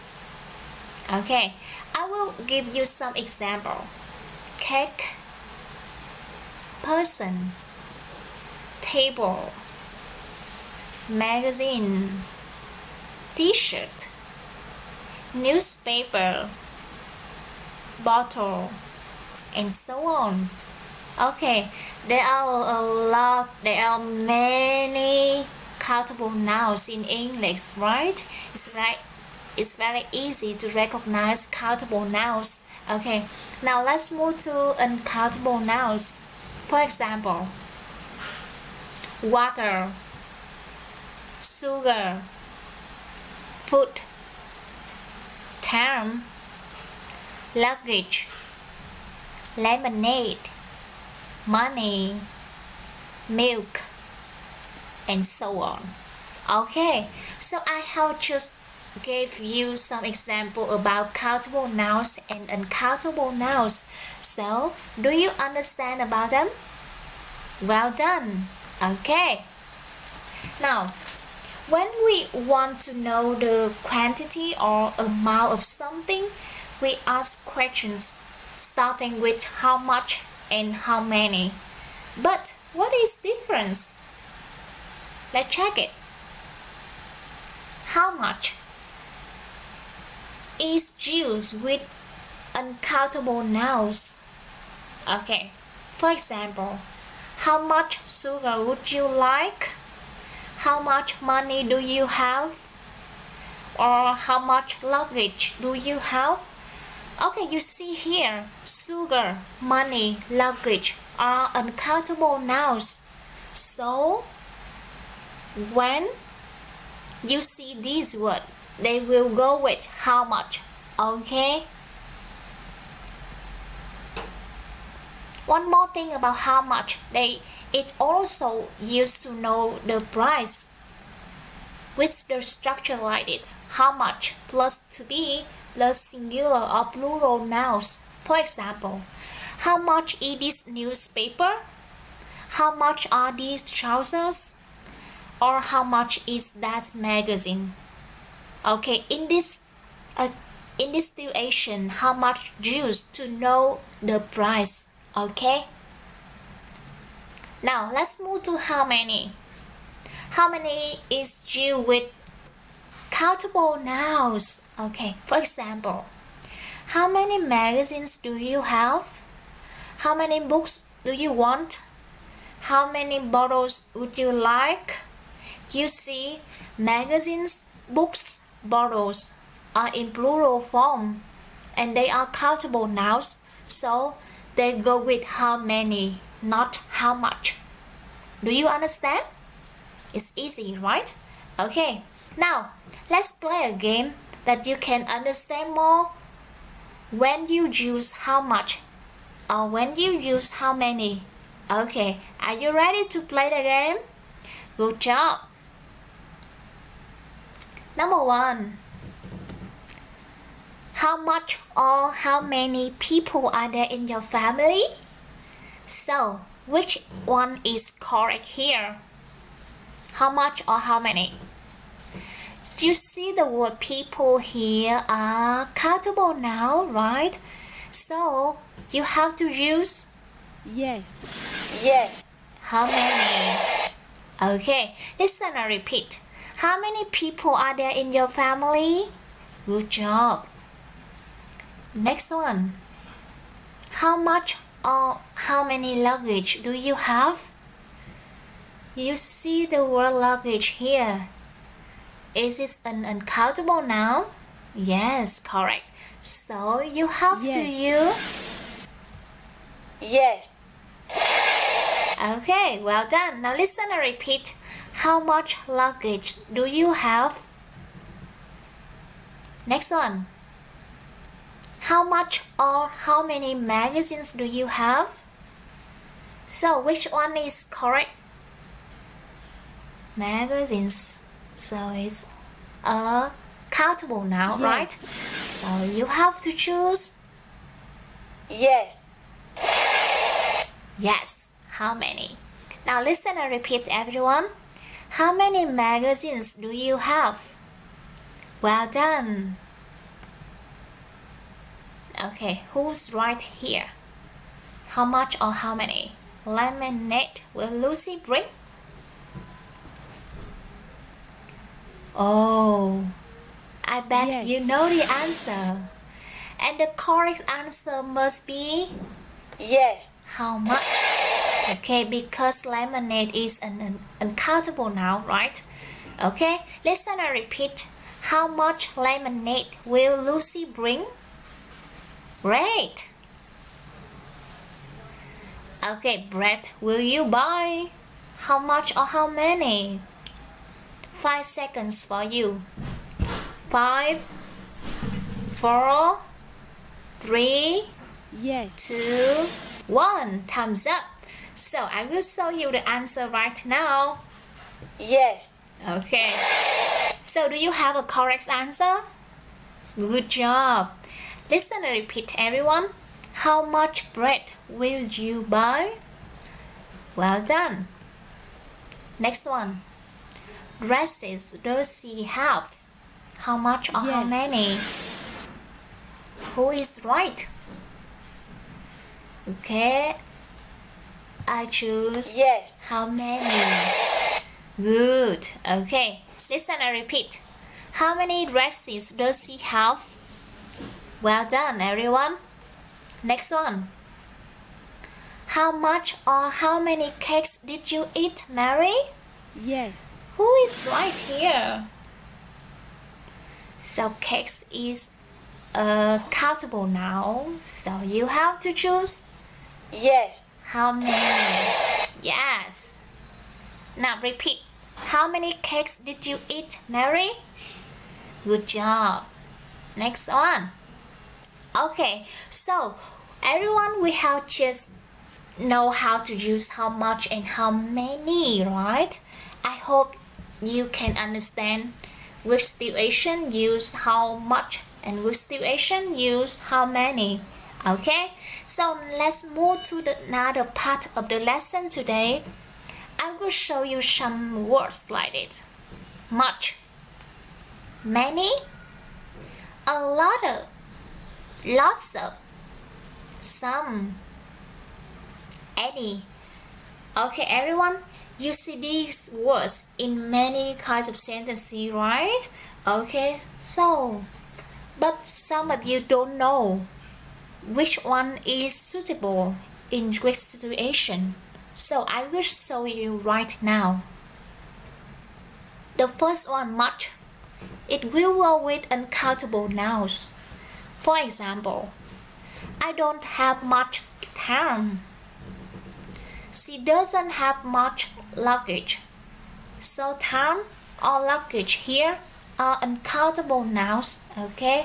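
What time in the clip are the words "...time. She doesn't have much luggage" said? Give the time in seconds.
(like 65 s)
484 s.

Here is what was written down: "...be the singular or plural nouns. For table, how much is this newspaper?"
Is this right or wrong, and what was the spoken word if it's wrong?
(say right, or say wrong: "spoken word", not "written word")
wrong: "example", not "table".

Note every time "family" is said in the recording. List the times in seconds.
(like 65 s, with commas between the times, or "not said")
214 s, 238 s.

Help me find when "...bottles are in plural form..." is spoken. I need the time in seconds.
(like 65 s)
178 s.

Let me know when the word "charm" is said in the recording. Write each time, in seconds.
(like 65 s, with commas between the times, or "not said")
45 s.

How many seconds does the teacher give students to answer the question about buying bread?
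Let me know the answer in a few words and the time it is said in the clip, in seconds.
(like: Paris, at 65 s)
5, at 341 s.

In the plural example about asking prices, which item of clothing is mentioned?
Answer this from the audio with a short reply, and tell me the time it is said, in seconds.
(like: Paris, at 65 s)
trousers, at 143 s.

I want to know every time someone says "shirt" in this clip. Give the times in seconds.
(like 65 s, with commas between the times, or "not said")
13 s.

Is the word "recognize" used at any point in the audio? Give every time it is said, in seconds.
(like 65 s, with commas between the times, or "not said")
30 s.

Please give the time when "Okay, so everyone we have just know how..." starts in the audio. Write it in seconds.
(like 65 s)
421 s.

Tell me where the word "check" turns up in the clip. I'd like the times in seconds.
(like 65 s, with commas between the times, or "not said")
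85 s.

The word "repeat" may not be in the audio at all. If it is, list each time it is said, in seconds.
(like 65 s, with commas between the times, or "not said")
235 s, 264 s, 293 s, 327 s, 361 s, 387 s, 414 s.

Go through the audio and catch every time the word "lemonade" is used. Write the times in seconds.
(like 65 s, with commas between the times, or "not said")
49 s, 306 s, 322 s, 328 s.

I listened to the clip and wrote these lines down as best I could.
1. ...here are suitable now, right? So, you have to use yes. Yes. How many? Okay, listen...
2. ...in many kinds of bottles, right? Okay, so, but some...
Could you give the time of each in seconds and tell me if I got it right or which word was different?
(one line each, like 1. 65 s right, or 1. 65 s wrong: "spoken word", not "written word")
1. 224 s wrong: "countable", not "suitable"
2. 459 s wrong: "sentences", not "bottles".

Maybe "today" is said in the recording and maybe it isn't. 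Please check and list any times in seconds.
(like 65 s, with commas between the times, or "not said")
441 s.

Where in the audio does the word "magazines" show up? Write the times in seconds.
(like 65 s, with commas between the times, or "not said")
11 s, 146 s, 167 s, 176 s, 273 s, 280 s, 295 s.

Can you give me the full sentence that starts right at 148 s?
Okay, in this uh, in this situation, how much use to know the price?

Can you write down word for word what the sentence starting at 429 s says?
I hope you can understand which situation use how much and which situation use how many.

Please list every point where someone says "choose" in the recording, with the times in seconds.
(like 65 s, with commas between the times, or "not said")
286 s, 381 s, 408 s.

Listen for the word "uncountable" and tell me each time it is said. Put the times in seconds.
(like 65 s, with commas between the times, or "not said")
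34 s, 62 s, 92 s, 111 s, 253 s, 324 s, 478 s, 492 s.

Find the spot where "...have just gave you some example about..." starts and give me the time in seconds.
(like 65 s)
57 s.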